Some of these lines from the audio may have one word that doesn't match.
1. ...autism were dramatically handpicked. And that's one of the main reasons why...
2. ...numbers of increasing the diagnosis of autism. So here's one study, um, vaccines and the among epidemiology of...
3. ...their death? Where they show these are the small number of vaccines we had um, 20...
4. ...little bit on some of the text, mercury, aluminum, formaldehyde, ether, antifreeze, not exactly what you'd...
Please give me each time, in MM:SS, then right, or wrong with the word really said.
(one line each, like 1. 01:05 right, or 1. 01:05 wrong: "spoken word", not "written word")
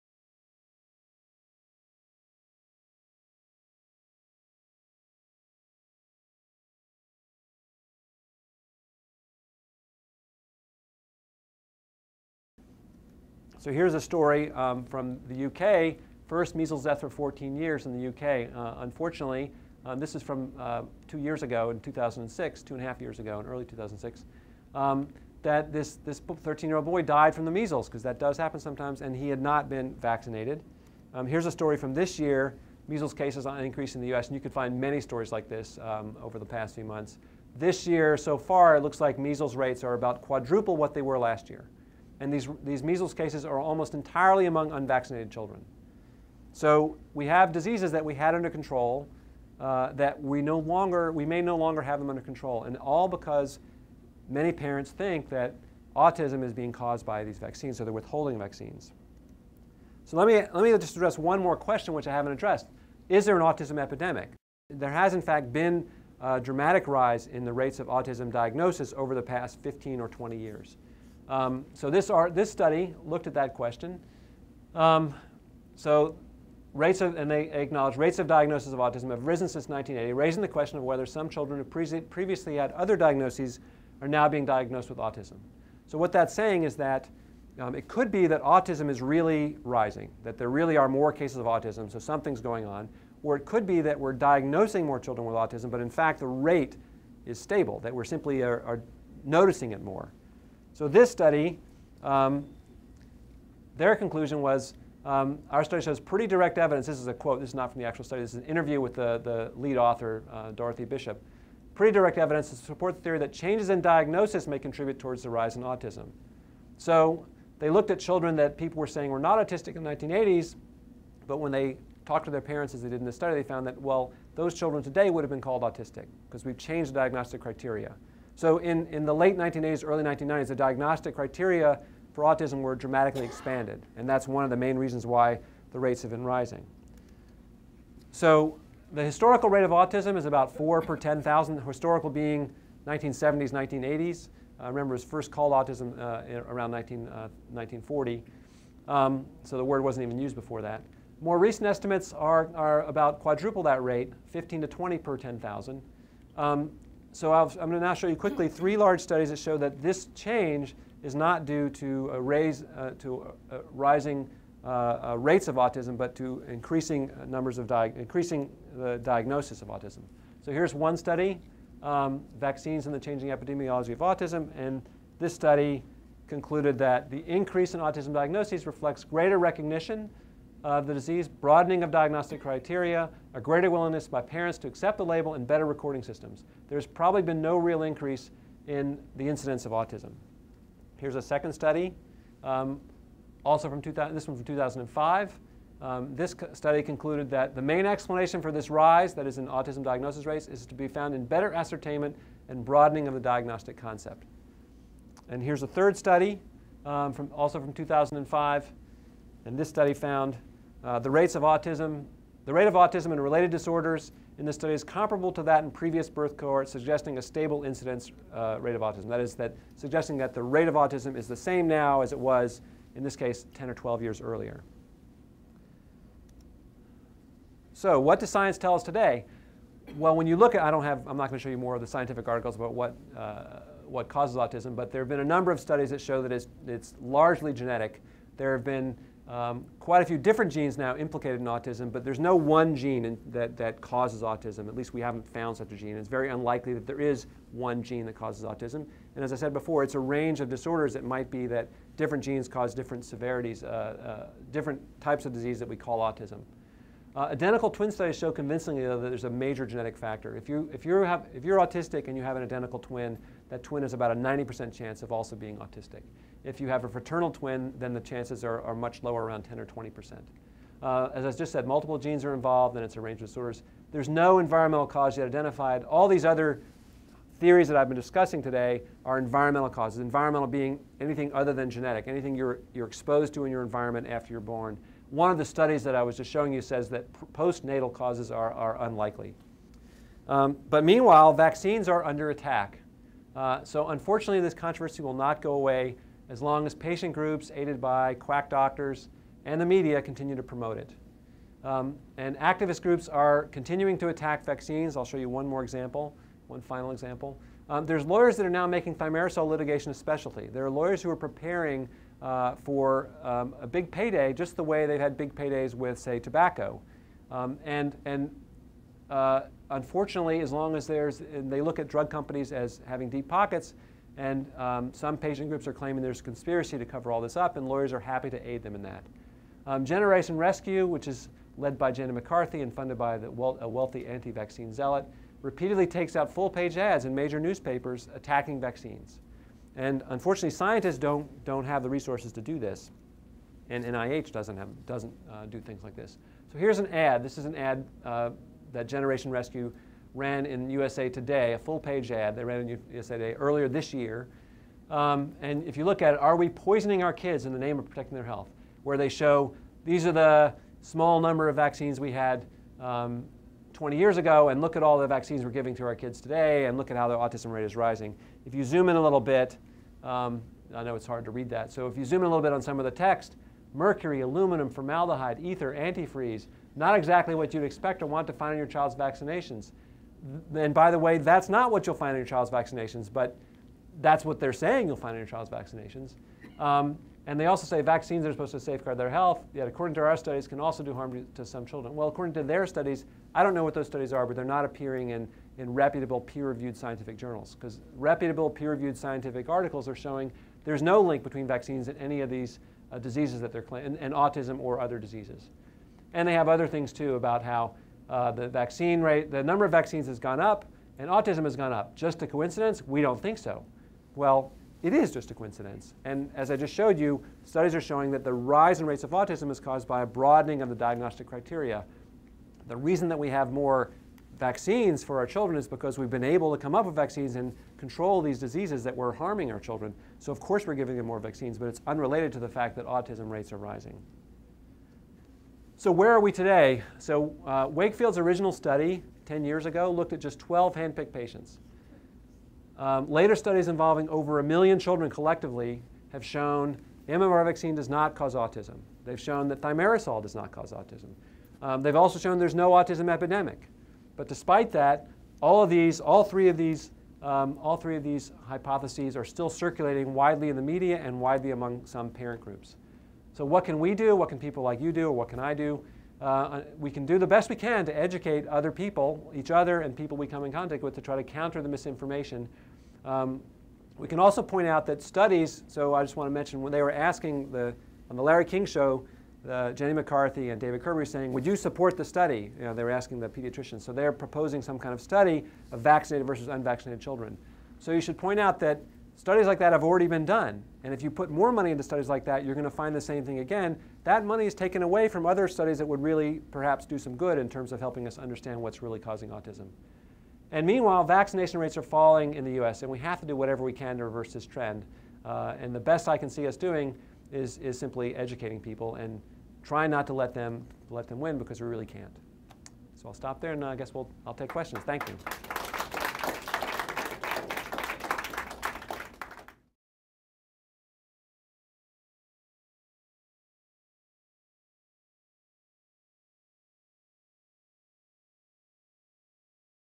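1. 02:12 wrong: "expanded", not "handpicked"
2. 02:47 wrong: "changing", not "among"
3. 05:58 wrong: "health", not "death"
4. 06:12 right.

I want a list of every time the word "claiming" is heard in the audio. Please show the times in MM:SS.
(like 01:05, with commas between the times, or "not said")
05:25, 06:43.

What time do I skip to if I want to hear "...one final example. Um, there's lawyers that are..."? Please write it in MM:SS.
05:06.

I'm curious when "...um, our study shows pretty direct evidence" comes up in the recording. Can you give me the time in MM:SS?
01:45.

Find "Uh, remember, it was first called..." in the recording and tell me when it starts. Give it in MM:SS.
02:24.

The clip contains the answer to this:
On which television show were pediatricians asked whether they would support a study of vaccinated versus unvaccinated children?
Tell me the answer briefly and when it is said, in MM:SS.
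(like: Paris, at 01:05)
Larry King show, at 07:58.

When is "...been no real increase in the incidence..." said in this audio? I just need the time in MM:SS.
03:07.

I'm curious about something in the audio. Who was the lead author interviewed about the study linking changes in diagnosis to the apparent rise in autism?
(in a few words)
Dorothy Bishop.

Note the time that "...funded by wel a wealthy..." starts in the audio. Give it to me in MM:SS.
05:32.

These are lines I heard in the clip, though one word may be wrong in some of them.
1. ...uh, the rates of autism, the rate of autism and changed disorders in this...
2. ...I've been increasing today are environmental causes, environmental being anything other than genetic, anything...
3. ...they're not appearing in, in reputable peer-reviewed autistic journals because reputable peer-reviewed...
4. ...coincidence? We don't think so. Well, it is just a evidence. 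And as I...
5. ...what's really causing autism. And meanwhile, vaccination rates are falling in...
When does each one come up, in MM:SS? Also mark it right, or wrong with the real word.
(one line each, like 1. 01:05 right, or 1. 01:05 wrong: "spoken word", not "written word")
1. 03:30 wrong: "related", not "changed"
2. 04:37 wrong: "discussing", not "increasing"
3. 06:34 wrong: "scientific", not "autistic"
4. 06:52 wrong: "coincidence", not "evidence"
5. 08:18 right.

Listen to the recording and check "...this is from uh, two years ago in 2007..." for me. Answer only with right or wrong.
wrong.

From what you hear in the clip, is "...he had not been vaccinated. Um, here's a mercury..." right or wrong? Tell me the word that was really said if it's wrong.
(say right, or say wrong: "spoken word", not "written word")
wrong: "story", not "mercury".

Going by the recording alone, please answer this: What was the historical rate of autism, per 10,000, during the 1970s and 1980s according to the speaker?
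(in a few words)
4 per 10,000.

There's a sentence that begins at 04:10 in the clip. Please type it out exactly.
It might be that different genes cause different severities, uh, uh, different types of disease that we call autism.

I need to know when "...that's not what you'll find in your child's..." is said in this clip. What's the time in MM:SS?
06:21.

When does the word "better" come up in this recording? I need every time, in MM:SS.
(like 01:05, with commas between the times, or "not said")
03:05, 03:21.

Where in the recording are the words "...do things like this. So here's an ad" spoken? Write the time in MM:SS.
05:45.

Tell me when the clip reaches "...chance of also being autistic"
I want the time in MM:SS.
04:24.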